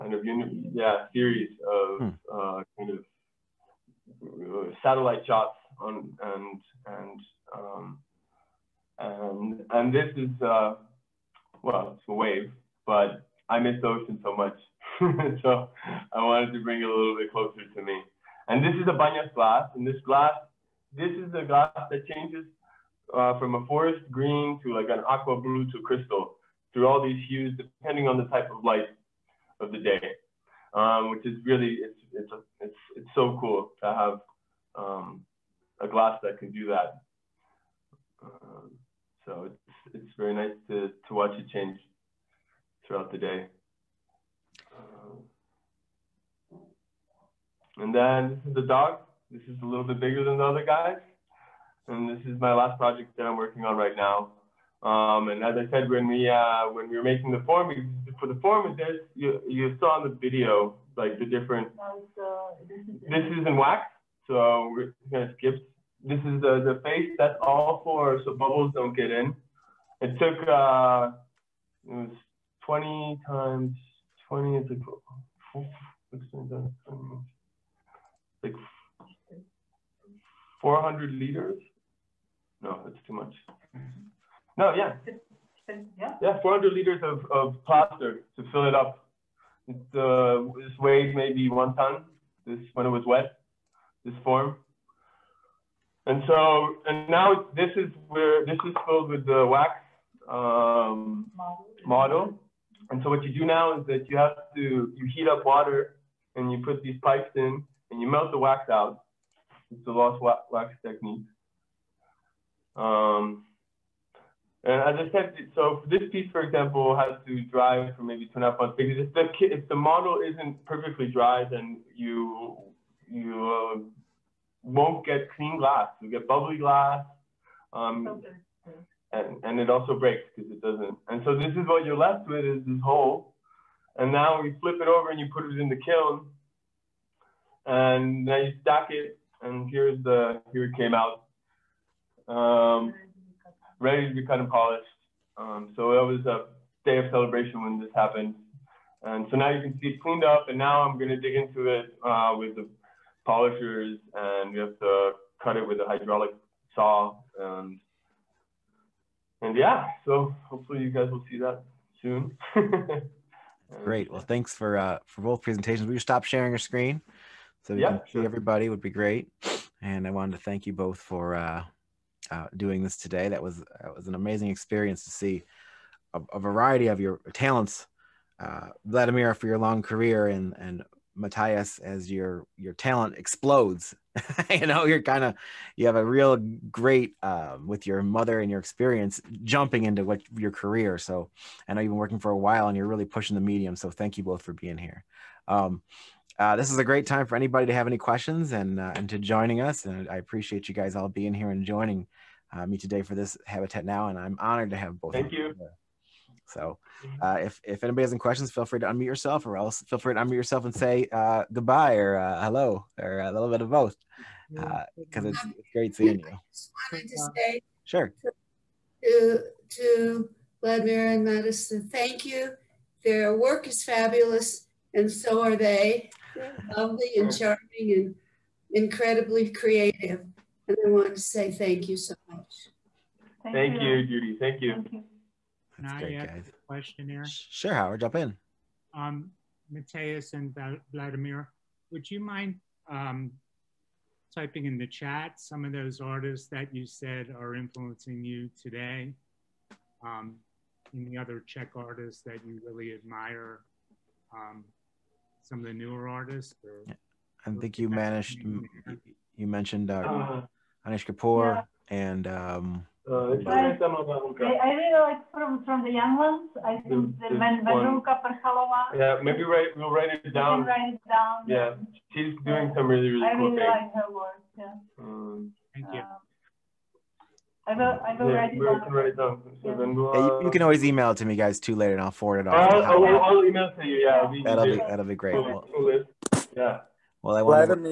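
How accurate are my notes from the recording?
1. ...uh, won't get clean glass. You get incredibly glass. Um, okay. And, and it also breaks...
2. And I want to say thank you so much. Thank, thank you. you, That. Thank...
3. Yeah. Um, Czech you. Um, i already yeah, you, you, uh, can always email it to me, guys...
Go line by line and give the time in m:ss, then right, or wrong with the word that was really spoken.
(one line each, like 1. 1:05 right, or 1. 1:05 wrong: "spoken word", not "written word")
1. 2:03 wrong: "bubbly", not "incredibly"
2. 3:50 wrong: "Judy", not "That"
3. 4:34 wrong: "Thank", not "Czech".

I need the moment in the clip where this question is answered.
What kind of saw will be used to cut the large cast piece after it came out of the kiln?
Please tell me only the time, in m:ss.
2:35.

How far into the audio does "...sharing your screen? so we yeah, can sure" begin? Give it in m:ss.
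2:46.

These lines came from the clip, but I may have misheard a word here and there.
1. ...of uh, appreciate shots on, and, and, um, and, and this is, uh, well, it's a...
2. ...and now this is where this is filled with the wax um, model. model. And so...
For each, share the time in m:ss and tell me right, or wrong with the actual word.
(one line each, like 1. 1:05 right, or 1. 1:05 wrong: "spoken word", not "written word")
1. 0:02 wrong: "satellite", not "appreciate"
2. 1:36 right.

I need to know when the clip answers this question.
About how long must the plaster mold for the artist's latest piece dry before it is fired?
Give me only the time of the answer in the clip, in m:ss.
1:58.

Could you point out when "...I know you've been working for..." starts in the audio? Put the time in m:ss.
3:11.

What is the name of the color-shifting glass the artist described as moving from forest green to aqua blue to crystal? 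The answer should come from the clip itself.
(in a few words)
Baños glass.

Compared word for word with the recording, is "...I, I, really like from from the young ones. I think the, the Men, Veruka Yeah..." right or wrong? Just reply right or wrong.
right.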